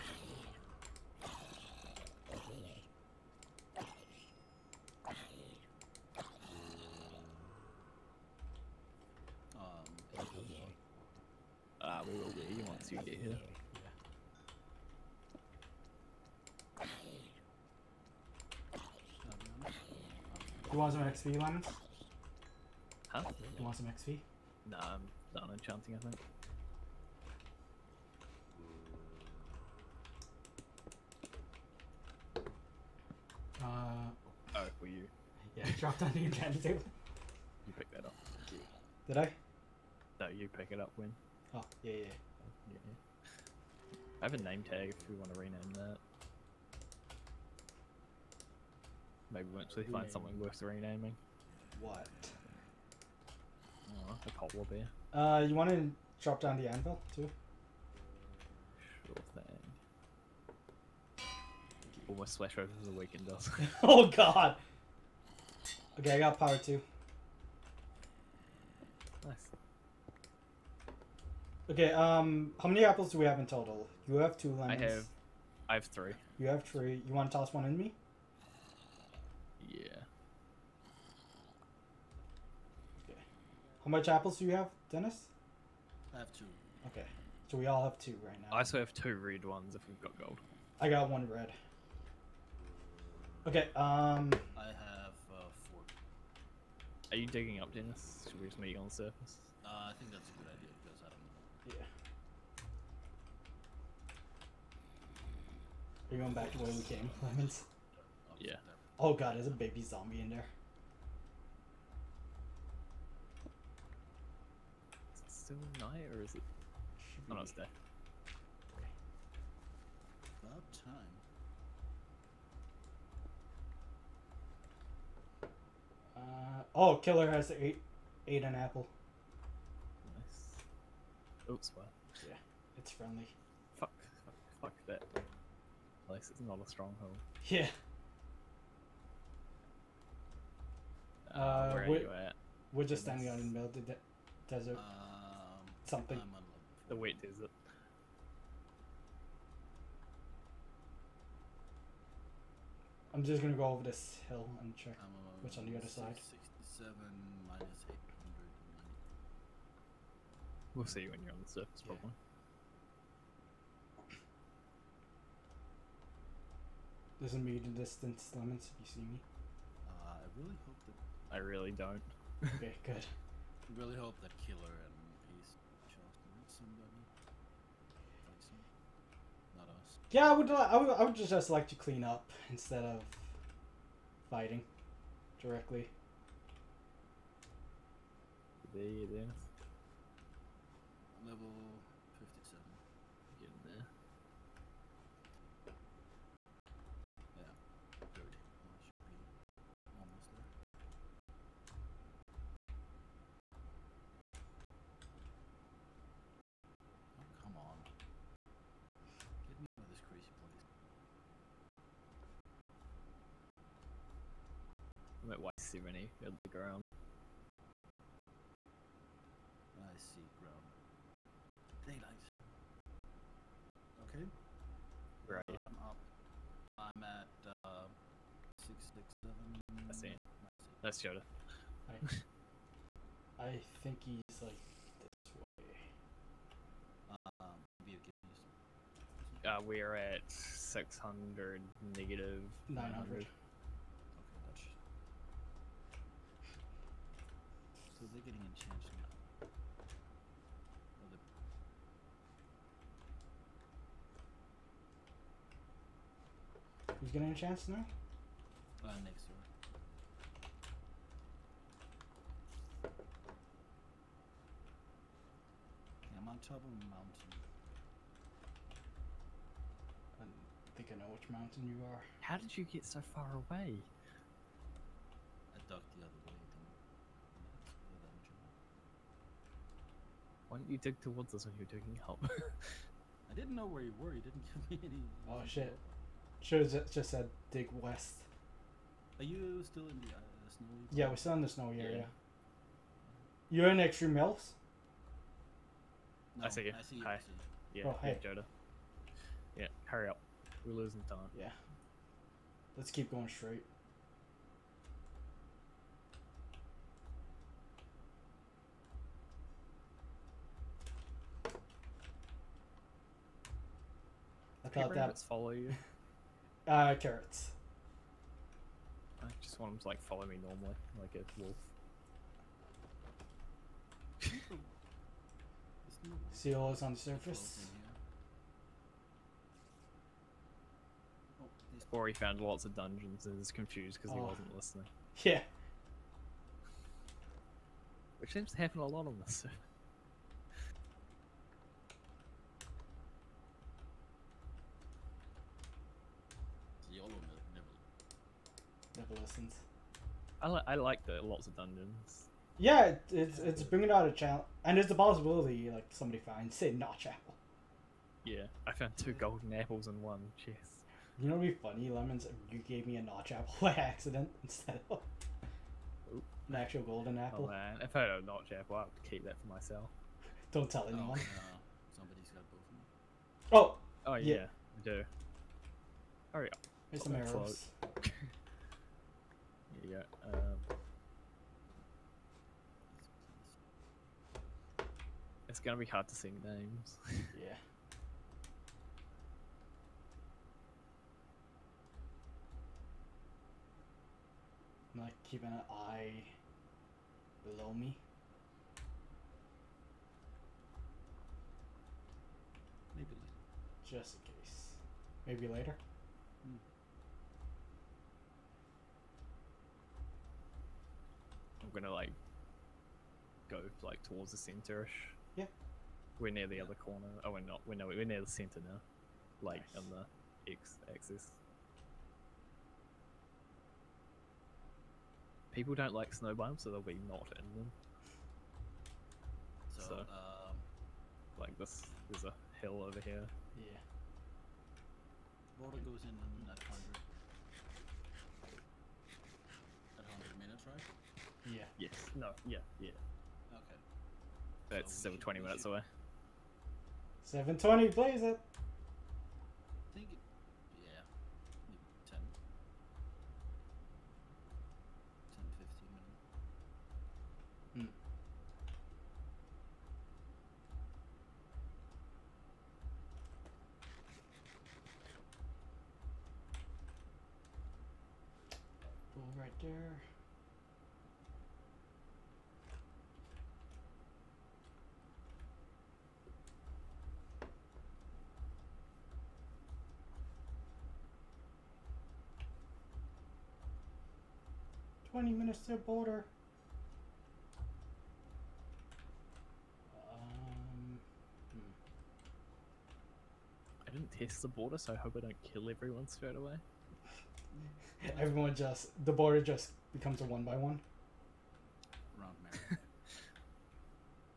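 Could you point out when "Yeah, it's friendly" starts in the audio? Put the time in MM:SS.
02:12.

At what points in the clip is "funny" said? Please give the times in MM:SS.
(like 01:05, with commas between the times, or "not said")
06:01.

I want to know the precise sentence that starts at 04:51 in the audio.
Yeah, we're still in the snowy yeah.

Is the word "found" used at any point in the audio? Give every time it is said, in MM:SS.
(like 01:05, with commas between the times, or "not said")
05:32, 05:58.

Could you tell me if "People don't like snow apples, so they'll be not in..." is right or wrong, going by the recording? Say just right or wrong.
wrong.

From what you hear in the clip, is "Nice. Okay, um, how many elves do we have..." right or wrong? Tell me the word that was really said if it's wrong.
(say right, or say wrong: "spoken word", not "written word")
wrong: "apples", not "elves".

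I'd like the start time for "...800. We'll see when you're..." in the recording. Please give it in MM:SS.
02:37.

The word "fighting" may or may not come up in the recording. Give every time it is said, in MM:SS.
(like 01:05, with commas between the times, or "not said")
03:04.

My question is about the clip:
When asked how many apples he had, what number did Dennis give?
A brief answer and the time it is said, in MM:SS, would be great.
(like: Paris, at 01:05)
2, at 01:26.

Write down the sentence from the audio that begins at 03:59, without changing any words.
Uh, we're at 600 negative 900.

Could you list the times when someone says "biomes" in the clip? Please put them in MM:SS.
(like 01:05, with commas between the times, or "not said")
07:06.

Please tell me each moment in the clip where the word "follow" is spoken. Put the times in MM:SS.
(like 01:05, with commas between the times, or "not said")
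05:15, 05:20.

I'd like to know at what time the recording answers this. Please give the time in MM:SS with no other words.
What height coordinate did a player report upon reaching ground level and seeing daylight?
03:35.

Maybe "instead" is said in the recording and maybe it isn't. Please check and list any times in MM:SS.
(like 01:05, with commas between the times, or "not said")
03:02, 06:04.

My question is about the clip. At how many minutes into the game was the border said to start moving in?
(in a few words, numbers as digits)
100.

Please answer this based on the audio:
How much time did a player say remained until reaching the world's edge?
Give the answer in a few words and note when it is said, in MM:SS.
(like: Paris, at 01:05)
20 minutes, at 08:05.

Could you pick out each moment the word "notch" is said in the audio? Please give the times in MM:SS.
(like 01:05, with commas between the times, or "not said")
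06:03, 06:08.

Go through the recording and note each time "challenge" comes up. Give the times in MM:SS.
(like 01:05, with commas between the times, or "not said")
05:54.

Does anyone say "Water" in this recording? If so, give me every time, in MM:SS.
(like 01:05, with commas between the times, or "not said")
07:15.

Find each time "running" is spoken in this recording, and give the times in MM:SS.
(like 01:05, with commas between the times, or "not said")
not said.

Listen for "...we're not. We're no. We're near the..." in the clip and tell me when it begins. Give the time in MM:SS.
06:57.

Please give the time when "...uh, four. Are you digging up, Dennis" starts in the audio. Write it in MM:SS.
01:35.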